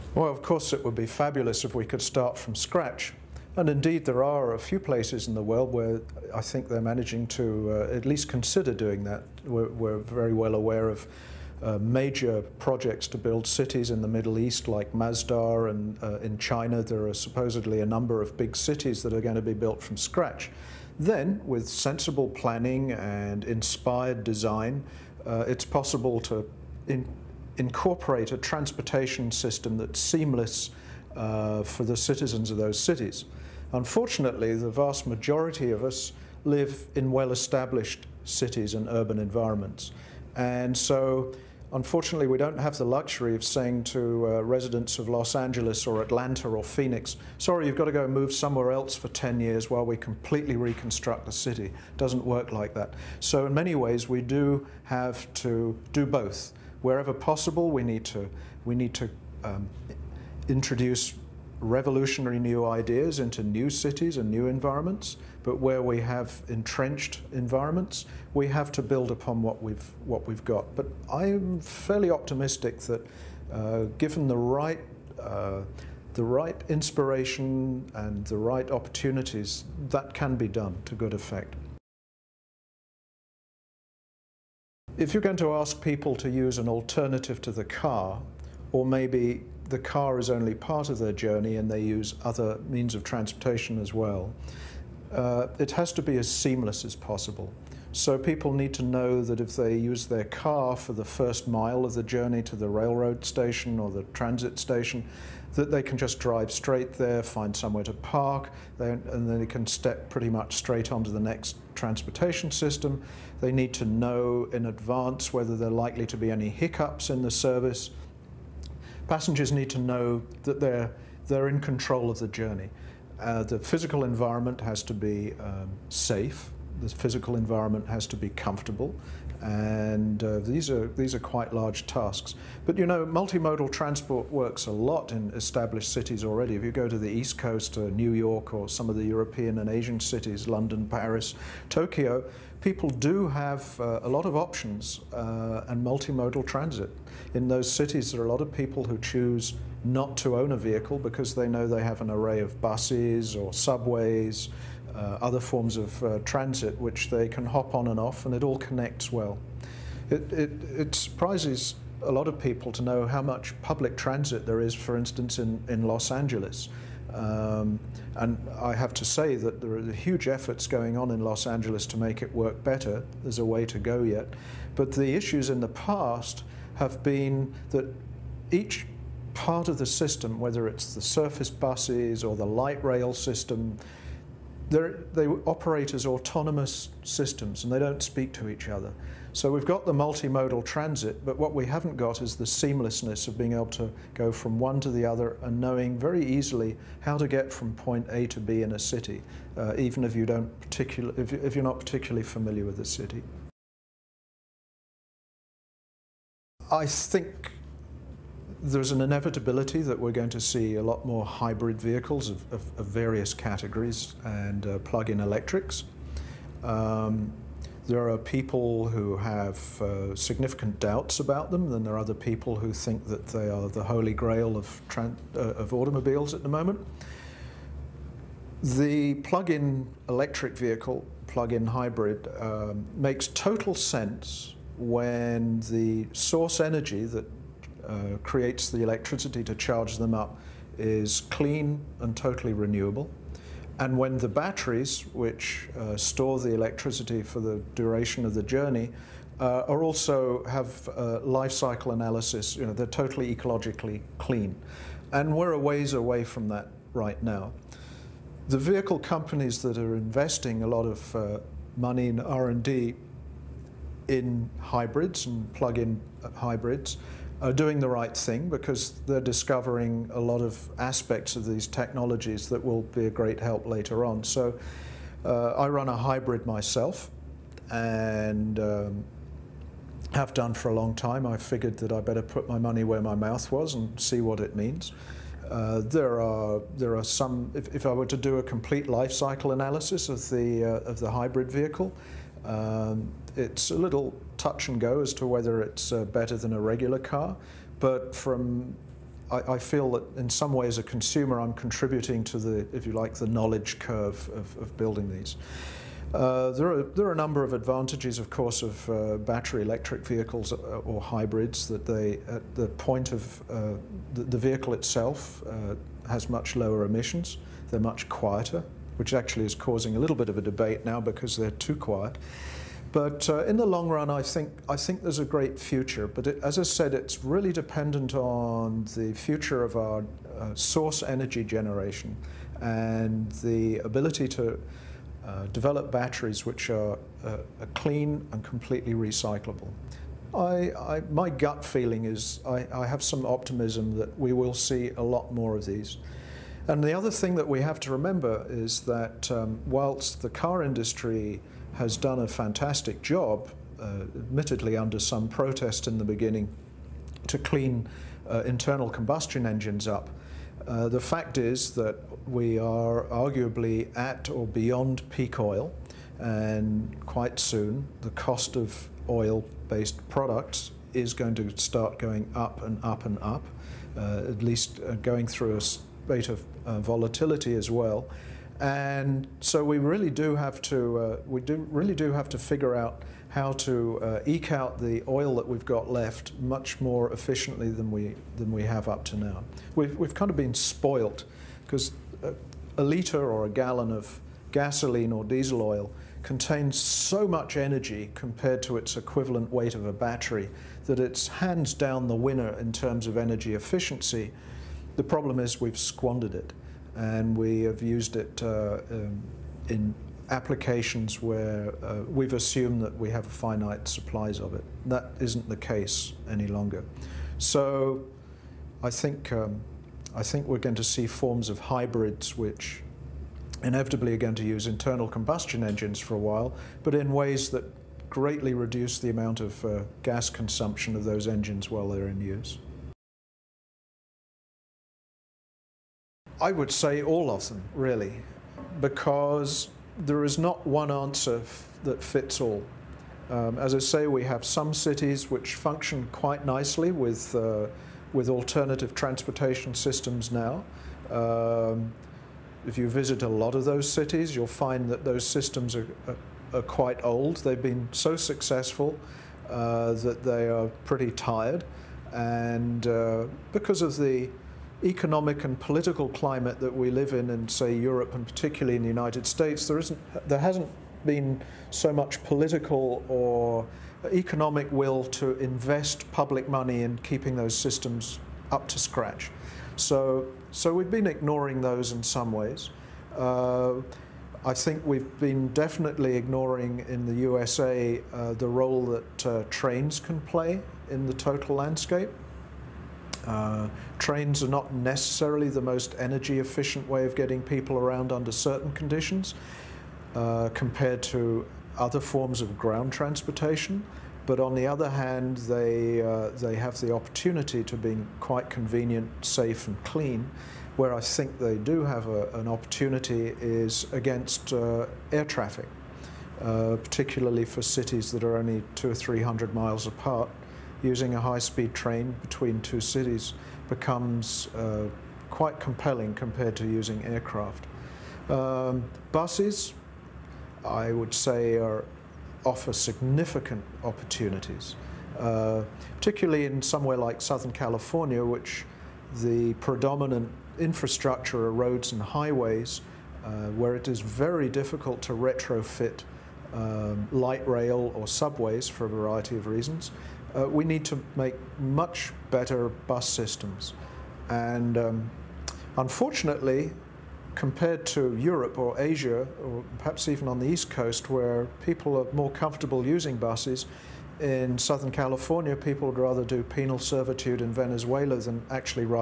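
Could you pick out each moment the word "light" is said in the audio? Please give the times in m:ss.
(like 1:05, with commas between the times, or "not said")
3:02, 9:07.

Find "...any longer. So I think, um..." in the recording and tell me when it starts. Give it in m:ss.
6:56.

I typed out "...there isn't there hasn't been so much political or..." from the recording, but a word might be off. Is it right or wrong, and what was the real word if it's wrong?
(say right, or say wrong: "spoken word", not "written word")
right.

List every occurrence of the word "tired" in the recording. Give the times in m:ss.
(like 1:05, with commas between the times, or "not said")
7:41.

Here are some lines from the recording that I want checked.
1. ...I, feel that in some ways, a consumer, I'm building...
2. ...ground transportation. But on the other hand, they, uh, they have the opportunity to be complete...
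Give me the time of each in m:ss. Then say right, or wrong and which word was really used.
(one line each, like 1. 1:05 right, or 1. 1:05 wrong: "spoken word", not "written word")
1. 4:59 wrong: "contributing", not "building"
2. 8:22 wrong: "quite", not "complete".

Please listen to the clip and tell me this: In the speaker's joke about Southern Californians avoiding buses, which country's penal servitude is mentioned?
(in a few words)
Venezuela.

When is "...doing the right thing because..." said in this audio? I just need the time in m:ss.
4:27.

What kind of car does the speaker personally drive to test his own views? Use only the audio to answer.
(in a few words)
a hybrid.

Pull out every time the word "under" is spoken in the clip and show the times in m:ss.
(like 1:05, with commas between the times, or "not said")
5:54, 8:18.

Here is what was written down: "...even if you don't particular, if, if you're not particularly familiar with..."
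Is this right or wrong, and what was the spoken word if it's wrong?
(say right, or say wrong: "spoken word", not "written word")
right.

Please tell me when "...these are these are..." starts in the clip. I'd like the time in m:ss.
2:10.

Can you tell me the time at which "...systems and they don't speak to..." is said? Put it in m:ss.
3:07.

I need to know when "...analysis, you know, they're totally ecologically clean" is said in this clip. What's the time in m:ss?
4:11.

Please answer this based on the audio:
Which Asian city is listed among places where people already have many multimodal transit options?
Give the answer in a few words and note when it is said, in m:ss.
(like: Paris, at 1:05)
Tokyo, at 2:21.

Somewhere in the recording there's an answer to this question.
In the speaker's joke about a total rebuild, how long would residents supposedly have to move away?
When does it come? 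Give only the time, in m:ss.
0:49.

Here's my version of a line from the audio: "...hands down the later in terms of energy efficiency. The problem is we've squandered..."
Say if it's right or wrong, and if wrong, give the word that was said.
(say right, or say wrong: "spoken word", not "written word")
wrong: "winner", not "later".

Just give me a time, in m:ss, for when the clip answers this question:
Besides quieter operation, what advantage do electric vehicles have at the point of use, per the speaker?
5:16.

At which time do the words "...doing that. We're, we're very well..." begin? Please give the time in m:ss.
0:08.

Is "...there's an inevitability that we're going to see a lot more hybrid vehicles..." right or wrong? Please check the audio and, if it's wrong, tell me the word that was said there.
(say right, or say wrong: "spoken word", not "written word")
right.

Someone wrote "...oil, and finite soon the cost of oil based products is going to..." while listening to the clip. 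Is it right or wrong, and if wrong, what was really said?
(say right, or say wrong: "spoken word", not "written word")
wrong: "quite", not "finite".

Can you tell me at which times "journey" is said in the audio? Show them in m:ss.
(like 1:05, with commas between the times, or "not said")
1:31, 1:42, 2:02, 4:08.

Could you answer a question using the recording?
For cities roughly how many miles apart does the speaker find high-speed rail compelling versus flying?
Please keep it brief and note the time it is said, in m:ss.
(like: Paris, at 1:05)
200 or 300 miles, at 8:38.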